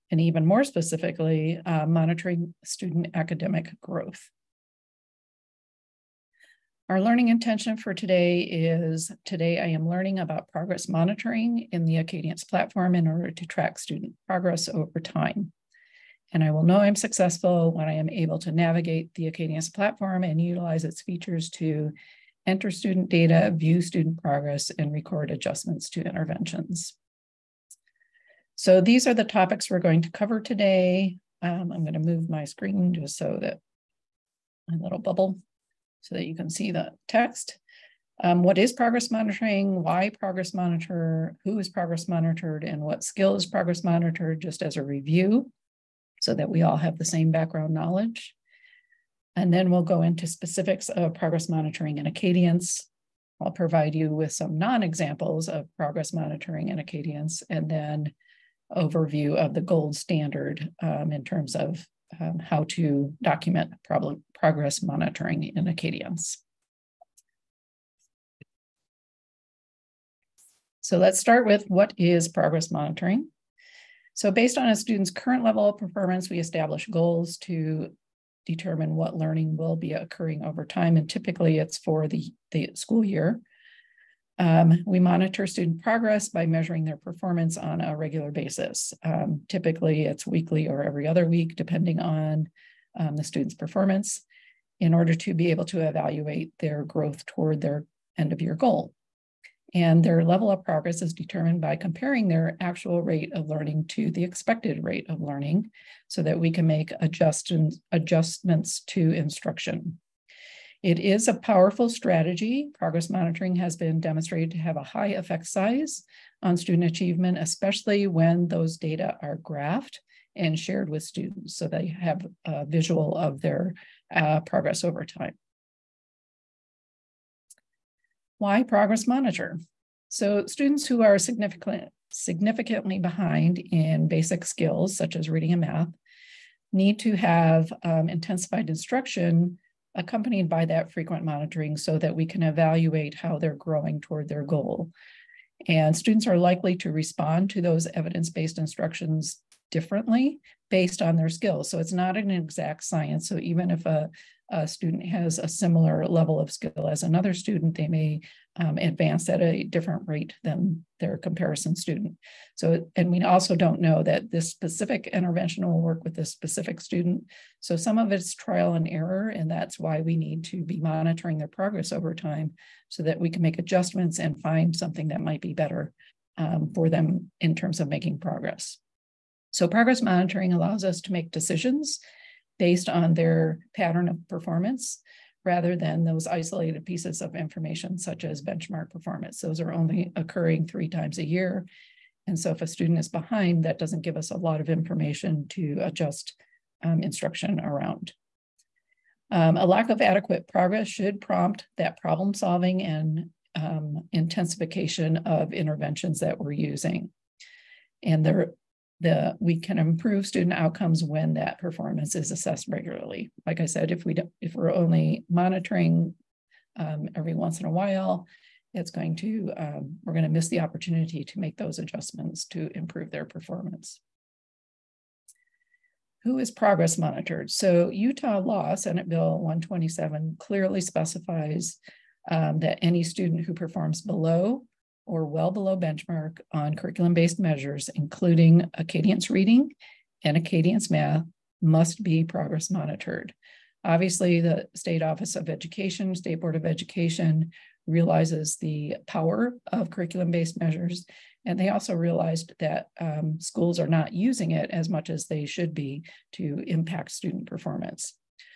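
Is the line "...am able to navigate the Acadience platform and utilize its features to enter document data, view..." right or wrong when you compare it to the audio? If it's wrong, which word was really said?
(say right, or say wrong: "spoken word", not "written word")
wrong: "student", not "document".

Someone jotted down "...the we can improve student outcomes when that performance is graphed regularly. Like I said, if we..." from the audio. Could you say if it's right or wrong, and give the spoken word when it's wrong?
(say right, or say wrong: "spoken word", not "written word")
wrong: "assessed", not "graphed".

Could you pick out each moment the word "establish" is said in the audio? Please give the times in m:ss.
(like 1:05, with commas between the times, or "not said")
1:16.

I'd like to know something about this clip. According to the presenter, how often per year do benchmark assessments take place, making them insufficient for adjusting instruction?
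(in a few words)
3 times a year.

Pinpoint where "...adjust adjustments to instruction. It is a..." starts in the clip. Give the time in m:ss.
1:46.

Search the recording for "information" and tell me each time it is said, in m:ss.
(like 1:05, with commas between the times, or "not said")
3:07, 3:14.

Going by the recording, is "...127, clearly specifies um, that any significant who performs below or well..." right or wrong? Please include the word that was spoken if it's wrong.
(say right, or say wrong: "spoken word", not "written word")
wrong: "student", not "significant".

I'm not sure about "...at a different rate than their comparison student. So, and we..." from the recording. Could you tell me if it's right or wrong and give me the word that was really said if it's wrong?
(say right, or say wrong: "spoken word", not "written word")
right.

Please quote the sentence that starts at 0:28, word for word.
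So these are the topics we're going to cover today.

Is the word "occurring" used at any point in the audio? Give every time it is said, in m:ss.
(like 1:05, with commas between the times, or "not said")
1:19, 3:10.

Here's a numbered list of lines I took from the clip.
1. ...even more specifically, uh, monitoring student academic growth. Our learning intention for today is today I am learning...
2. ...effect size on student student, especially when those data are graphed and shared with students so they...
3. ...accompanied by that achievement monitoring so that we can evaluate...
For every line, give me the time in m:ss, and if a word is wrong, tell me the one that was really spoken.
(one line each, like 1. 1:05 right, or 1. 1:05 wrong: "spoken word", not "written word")
1. 0:00 right
2. 1:55 wrong: "achievement", not "student"
3. 2:19 wrong: "frequent", not "achievement".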